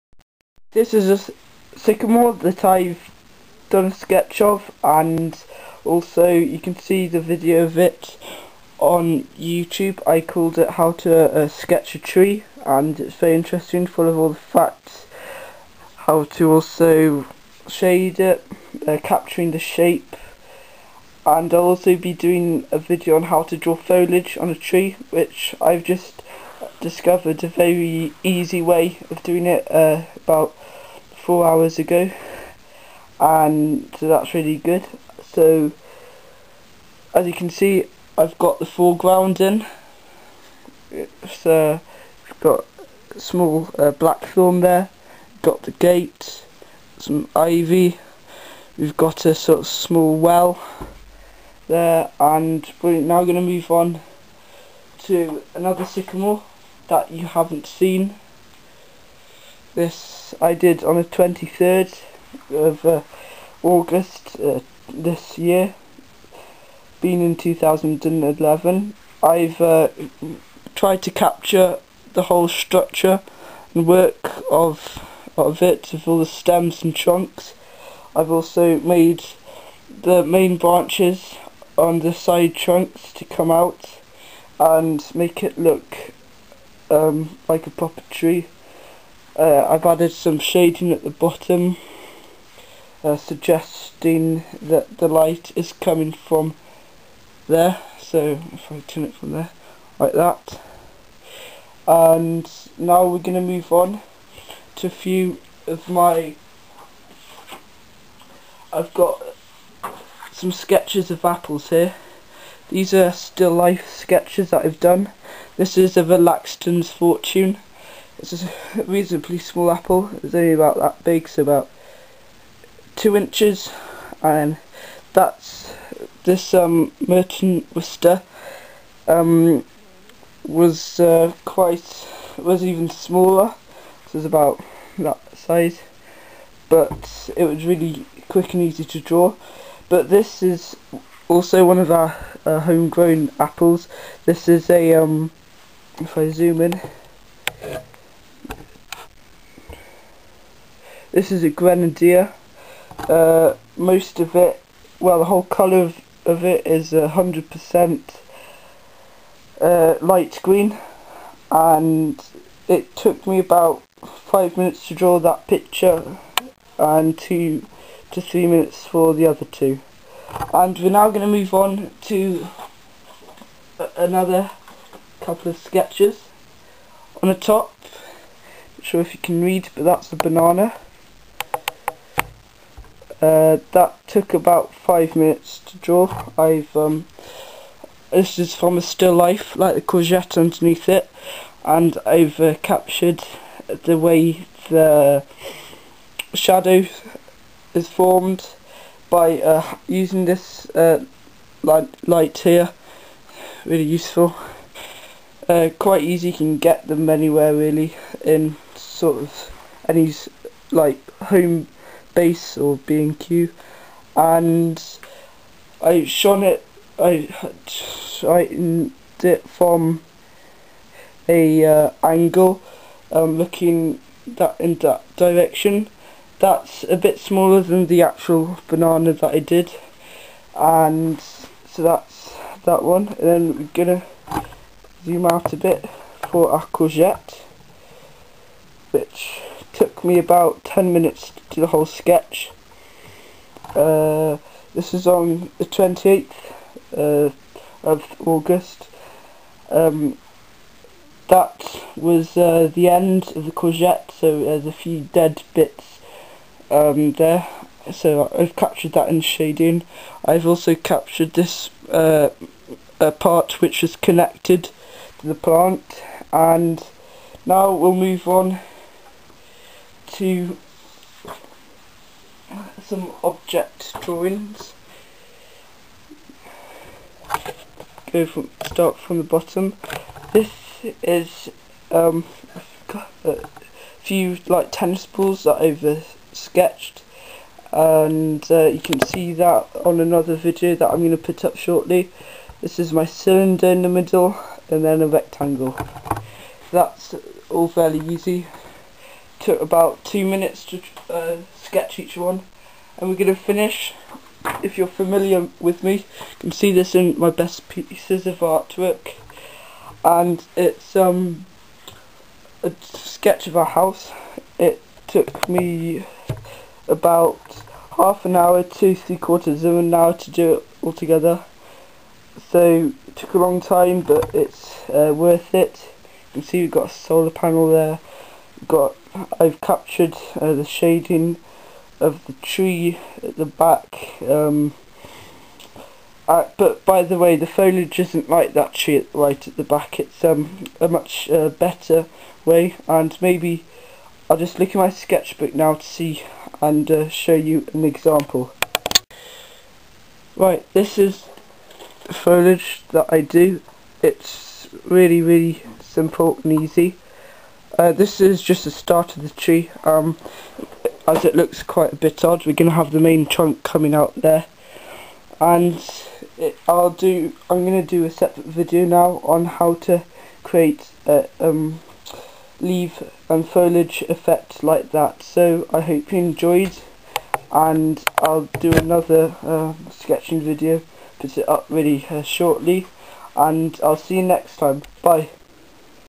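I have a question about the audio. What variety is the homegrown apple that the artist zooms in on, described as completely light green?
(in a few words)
Grenadier.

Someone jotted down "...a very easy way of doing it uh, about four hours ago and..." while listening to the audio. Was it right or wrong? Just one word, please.
right.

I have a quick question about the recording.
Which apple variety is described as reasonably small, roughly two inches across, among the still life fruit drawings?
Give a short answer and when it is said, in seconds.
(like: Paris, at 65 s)
Laxton's Fortune, at 116 s.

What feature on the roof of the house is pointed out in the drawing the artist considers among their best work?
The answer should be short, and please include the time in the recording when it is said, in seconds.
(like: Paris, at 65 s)
Solar panel, at 326 s.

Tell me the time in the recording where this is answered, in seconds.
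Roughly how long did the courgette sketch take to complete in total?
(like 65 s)
240 s.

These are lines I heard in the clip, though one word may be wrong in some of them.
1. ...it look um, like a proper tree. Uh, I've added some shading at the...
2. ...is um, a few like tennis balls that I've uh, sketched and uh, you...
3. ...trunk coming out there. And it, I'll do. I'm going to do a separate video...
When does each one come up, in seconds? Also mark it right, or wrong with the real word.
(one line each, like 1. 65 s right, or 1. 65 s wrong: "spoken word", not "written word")
1. 85 s right
2. 281 s right
3. 363 s right.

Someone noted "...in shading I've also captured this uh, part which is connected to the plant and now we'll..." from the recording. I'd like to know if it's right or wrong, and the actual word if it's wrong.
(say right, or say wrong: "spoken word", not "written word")
right.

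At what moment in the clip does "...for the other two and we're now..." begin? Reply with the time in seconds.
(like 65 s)
168 s.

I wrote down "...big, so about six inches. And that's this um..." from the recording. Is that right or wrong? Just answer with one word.
wrong.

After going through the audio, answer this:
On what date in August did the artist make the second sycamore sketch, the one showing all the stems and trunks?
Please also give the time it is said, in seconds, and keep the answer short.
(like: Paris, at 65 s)
23rd, at 61 s.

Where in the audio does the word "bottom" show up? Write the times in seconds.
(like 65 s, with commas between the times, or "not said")
91 s, 279 s.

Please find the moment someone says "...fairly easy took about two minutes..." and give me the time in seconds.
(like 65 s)
297 s.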